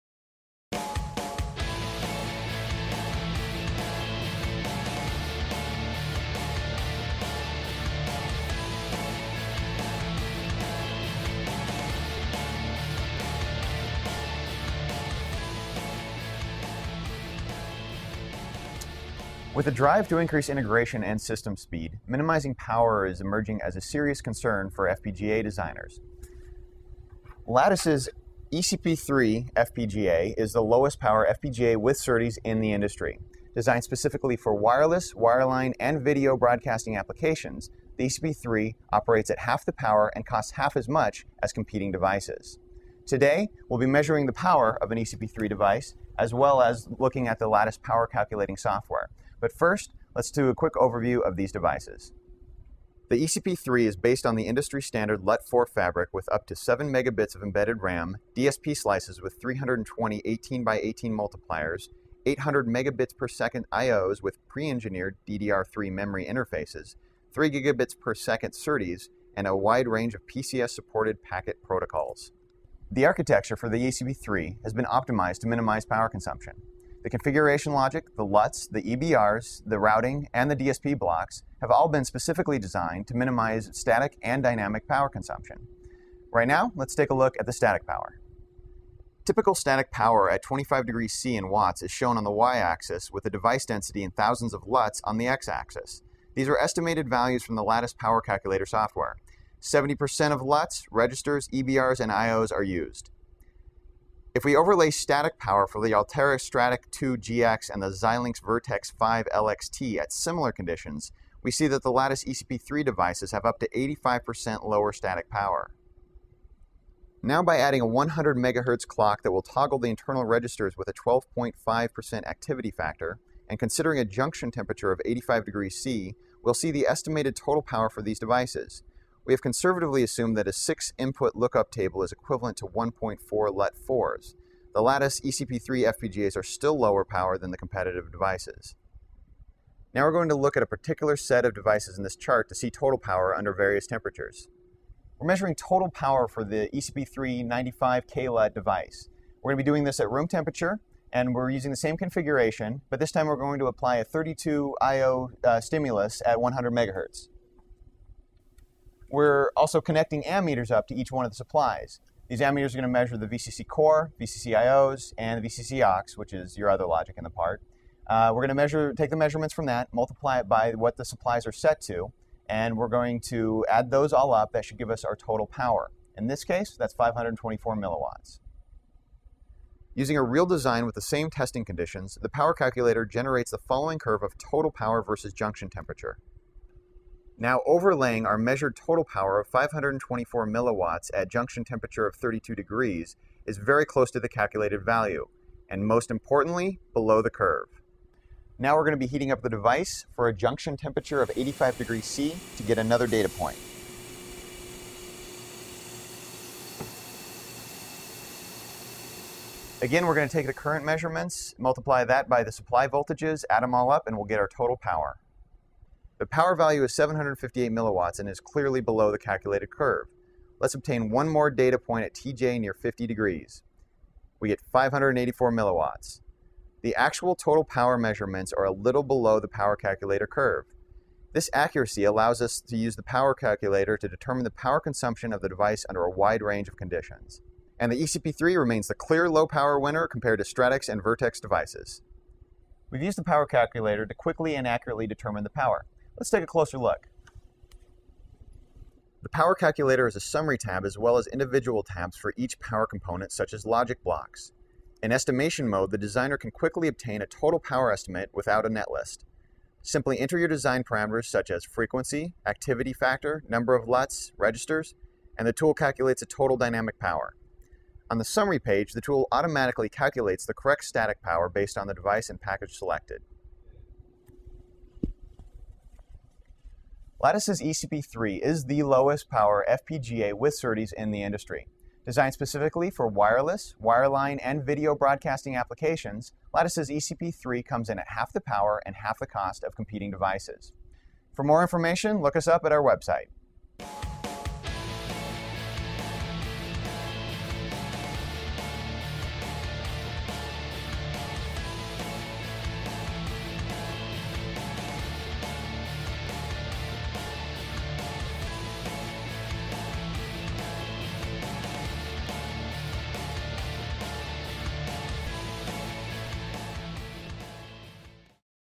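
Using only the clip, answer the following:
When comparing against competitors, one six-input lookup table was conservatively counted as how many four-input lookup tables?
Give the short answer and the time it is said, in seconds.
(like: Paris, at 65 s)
1.4, at 132 s.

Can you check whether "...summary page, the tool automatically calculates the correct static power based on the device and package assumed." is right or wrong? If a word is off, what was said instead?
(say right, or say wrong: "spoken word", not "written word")
wrong: "selected", not "assumed".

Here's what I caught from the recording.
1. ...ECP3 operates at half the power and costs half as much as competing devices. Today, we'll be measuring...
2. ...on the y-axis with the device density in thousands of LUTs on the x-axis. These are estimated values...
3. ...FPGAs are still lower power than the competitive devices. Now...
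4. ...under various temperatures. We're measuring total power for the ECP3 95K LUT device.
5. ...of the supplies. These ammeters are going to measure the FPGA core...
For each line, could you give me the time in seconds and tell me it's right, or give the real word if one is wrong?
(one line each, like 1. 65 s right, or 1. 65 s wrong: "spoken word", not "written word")
1. 38 s right
2. 92 s right
3. 135 s right
4. 143 s right
5. 161 s wrong: "VCC", not "FPGA".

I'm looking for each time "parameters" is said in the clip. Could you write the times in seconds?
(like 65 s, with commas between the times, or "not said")
260 s.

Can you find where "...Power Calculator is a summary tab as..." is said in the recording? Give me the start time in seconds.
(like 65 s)
249 s.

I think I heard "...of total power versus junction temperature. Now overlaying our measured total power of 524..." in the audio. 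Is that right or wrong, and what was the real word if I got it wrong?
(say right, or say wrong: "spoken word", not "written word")
right.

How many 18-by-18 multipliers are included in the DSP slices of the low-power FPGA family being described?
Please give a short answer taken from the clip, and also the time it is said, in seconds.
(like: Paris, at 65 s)
320, at 59 s.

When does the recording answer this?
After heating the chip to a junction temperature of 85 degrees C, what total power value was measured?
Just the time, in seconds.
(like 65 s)
216 s.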